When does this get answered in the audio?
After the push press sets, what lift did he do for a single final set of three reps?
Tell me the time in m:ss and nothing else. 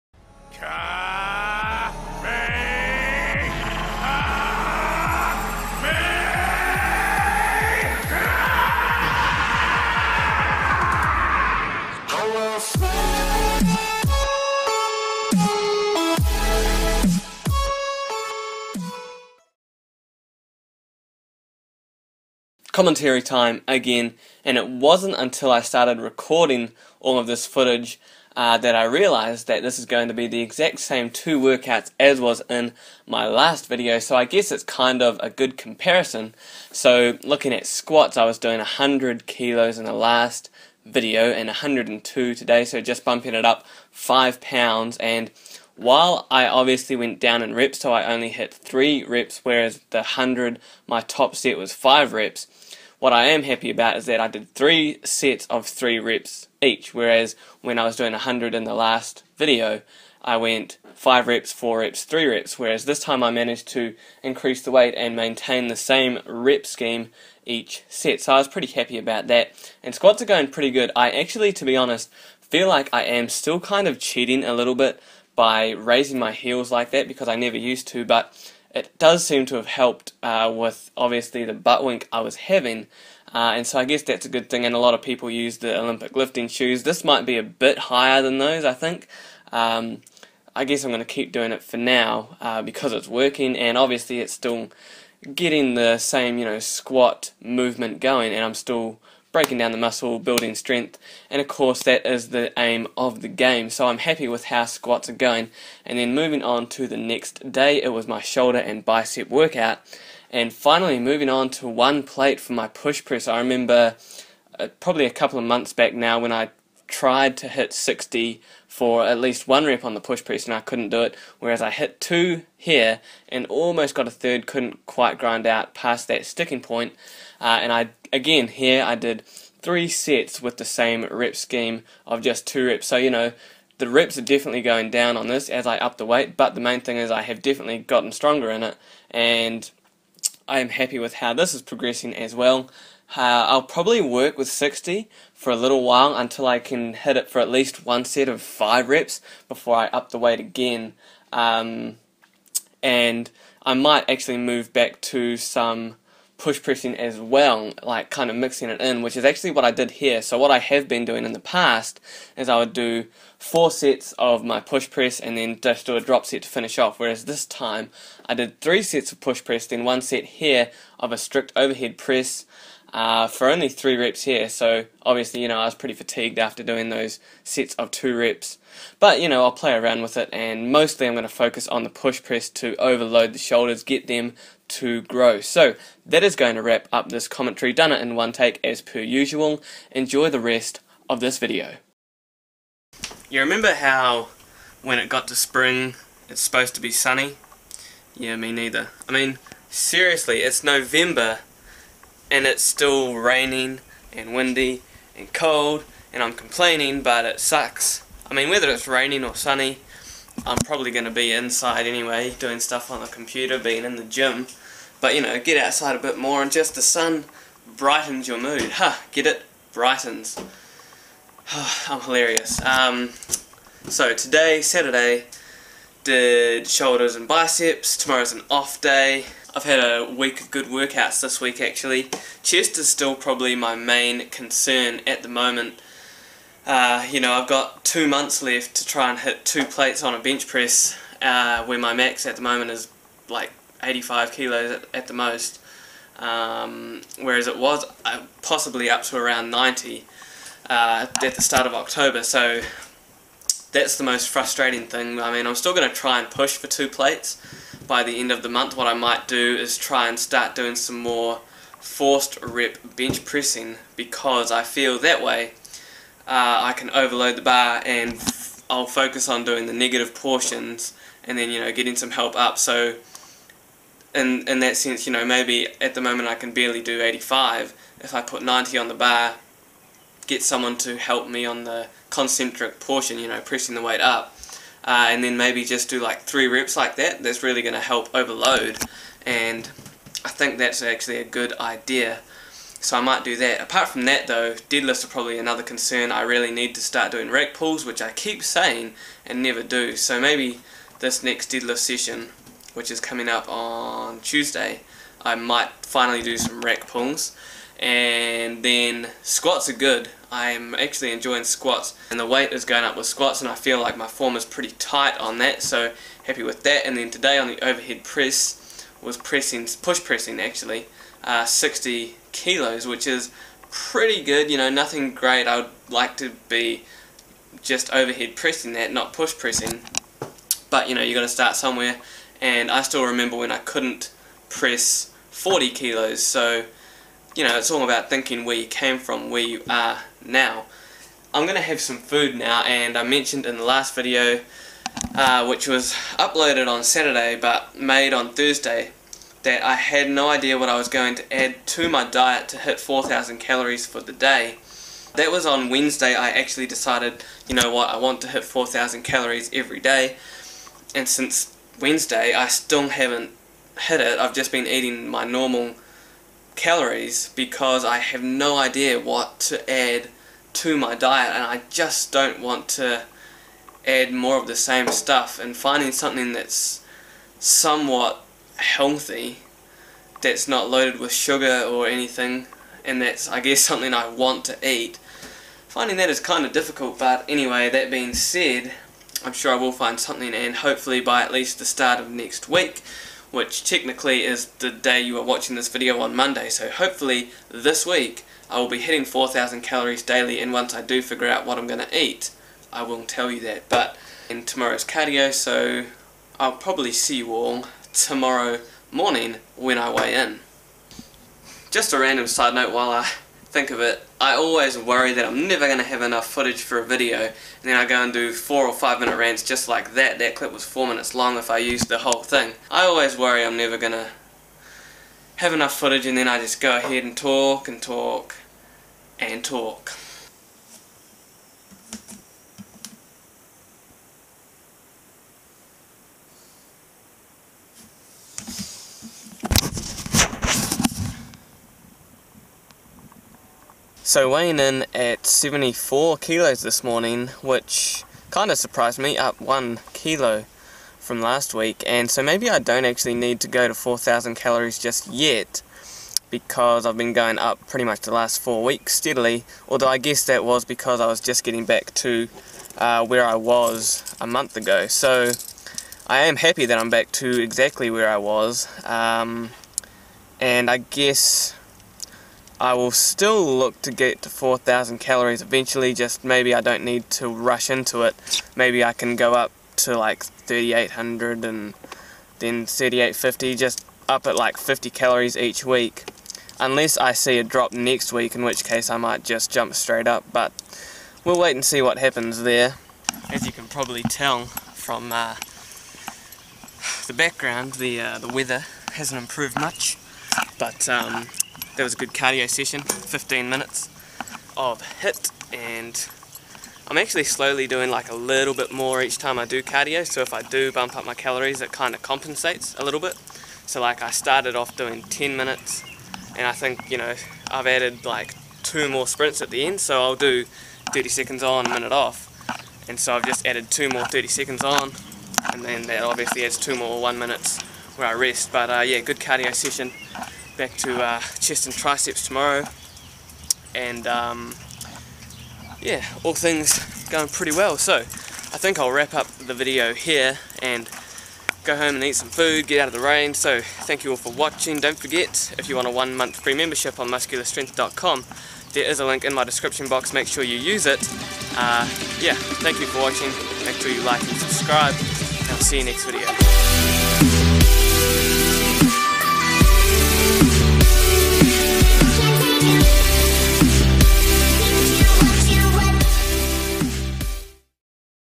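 2:51.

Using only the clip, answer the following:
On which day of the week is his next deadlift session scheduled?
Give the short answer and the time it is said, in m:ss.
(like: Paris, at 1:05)
Tuesday, at 5:04.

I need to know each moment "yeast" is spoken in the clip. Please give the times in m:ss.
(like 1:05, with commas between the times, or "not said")
not said.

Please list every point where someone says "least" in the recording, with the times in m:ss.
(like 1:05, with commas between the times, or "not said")
1:59, 2:27, 6:31.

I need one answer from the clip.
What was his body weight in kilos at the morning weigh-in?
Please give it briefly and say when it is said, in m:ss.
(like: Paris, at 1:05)
74, at 7:25.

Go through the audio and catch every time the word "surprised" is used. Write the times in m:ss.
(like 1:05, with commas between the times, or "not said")
7:28.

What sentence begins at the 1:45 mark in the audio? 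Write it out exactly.
And then moving on to the next day, it was my shoulder and bicep workout.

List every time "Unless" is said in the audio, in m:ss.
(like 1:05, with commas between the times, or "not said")
8:06.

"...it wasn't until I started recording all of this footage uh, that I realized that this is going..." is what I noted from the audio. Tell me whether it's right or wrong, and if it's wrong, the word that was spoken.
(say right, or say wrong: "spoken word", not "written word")
right.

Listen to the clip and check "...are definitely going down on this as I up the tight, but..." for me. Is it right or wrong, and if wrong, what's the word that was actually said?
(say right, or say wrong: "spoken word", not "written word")
wrong: "weight", not "tight".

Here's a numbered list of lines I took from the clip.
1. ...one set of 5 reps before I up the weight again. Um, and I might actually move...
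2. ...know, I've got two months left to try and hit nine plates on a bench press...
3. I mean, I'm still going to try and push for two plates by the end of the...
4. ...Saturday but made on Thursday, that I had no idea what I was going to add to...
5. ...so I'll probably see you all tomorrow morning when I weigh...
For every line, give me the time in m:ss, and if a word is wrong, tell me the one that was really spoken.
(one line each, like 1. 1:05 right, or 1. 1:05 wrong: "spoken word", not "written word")
1. 2:27 right
2. 3:57 wrong: "two", not "nine"
3. 4:15 right
4. 5:46 right
5. 6:45 right.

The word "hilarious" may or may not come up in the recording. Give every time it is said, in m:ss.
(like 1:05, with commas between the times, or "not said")
3:42.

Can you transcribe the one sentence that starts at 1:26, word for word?
This might be a bit higher than those, I think.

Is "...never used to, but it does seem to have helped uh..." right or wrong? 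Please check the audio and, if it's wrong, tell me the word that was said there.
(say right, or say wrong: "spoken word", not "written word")
right.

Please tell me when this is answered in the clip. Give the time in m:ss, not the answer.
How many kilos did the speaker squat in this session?
0:41.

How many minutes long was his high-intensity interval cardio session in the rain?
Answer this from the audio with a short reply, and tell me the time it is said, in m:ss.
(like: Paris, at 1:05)
15, at 8:22.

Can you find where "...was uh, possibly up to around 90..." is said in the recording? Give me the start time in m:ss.
4:07.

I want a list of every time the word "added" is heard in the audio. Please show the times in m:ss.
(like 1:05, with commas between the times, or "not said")
8:37, 8:43.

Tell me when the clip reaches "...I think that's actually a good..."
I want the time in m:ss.
4:50.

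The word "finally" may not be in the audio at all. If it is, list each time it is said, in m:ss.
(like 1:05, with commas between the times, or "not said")
1:50, 5:05.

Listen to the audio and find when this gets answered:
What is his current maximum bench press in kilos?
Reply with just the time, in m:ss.
4:03.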